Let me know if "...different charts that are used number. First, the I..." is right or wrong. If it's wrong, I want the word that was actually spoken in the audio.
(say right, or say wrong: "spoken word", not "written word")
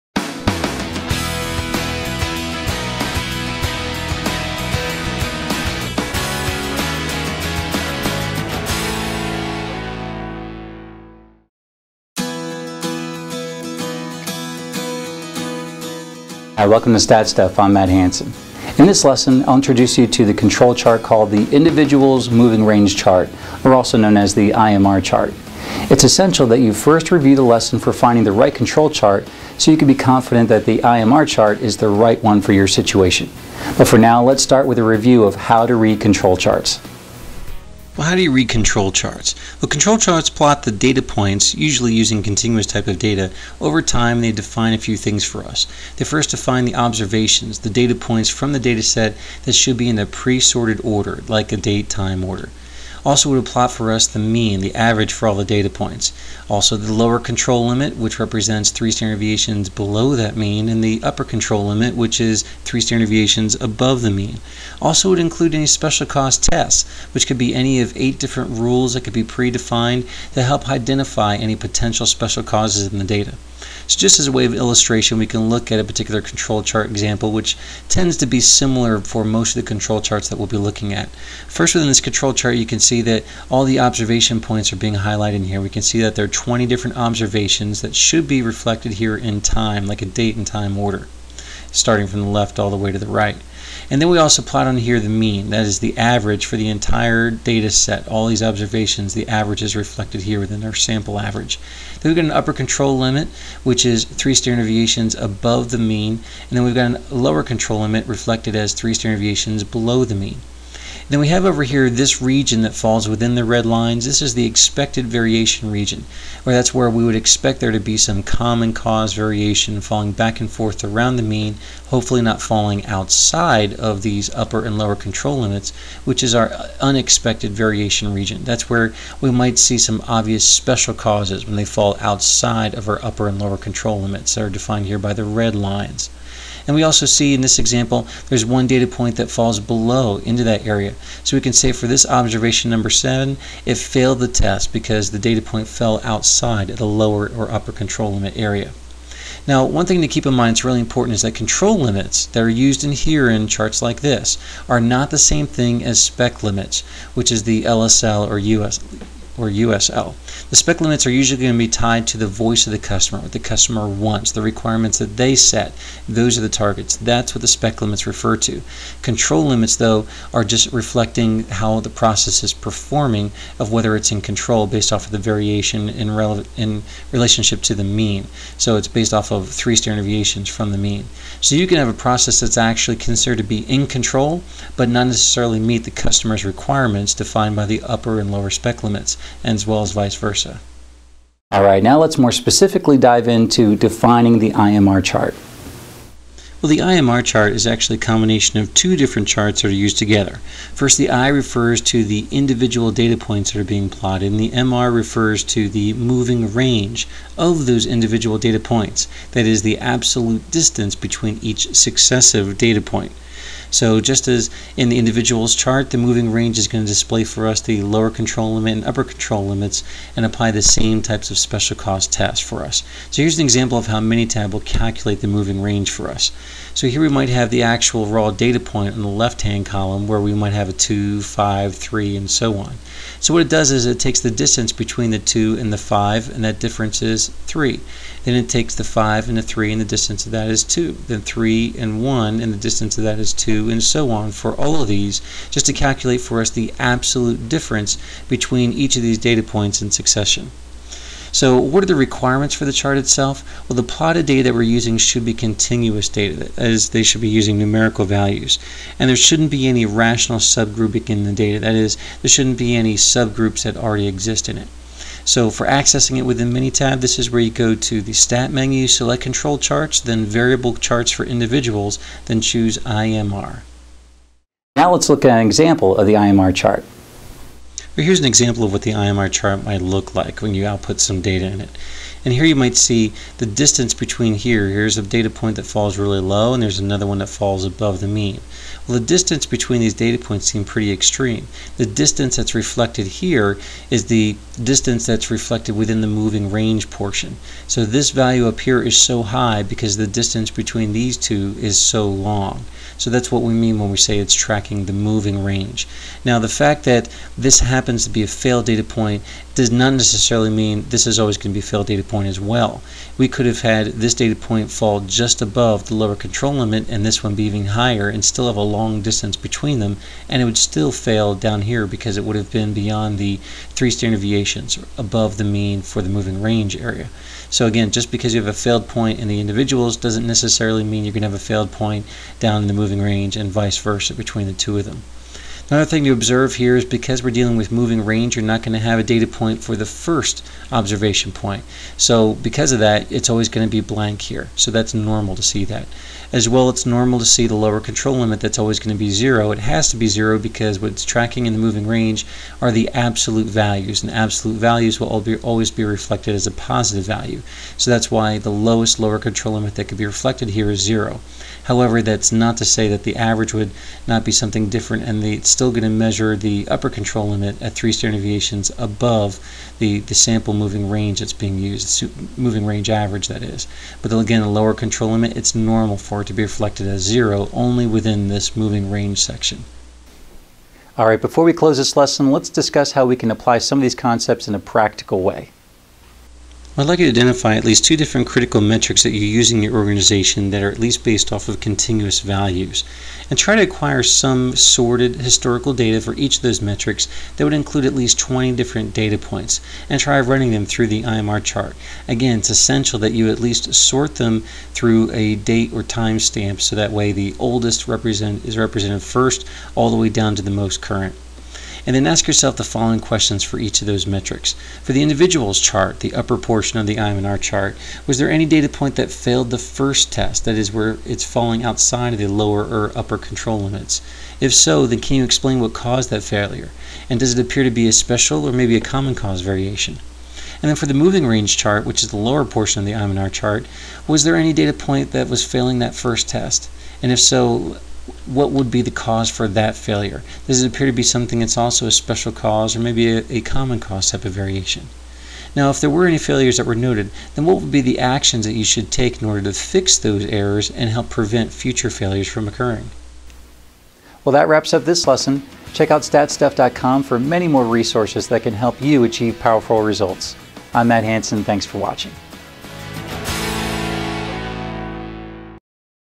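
wrong: "together", not "number".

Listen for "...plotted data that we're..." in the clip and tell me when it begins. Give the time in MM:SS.
04:13.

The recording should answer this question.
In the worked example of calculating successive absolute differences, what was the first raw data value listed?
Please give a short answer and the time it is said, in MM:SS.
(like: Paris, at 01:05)
2, at 03:50.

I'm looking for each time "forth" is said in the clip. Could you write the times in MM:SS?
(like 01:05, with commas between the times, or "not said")
02:00.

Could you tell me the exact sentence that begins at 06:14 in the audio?
But again, the lower control limit, it's normal for it to be reflected as zero only within this moving range section.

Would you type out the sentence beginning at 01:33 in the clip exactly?
And then we also plot on here the mean, that is the average for the entire data set.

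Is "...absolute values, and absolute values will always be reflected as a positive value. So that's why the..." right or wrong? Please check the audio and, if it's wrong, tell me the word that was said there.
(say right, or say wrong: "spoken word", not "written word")
right.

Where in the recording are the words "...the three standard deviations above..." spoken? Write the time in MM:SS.
05:23.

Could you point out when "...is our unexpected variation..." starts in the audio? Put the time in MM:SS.
02:06.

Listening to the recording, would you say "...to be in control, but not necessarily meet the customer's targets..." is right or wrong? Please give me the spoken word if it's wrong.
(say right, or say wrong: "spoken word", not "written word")
wrong: "requirements", not "targets".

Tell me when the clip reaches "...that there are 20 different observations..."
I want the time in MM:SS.
01:26.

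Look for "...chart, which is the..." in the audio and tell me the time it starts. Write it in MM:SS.
07:11.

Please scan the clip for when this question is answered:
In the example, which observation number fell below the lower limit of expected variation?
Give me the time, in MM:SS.
02:22.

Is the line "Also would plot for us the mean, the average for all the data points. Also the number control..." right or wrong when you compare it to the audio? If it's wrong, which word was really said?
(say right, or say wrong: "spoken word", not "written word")
wrong: "lower", not "number".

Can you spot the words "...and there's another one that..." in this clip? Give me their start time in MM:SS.
04:46.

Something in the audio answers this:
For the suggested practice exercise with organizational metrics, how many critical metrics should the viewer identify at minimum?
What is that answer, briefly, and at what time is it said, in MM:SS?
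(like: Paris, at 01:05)
2, at 06:27.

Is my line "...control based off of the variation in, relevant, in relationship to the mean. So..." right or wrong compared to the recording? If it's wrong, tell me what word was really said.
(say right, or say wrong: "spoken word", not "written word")
right.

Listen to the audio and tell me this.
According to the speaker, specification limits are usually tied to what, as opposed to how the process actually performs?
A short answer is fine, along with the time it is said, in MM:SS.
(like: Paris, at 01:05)
voice of the customer, at 02:42.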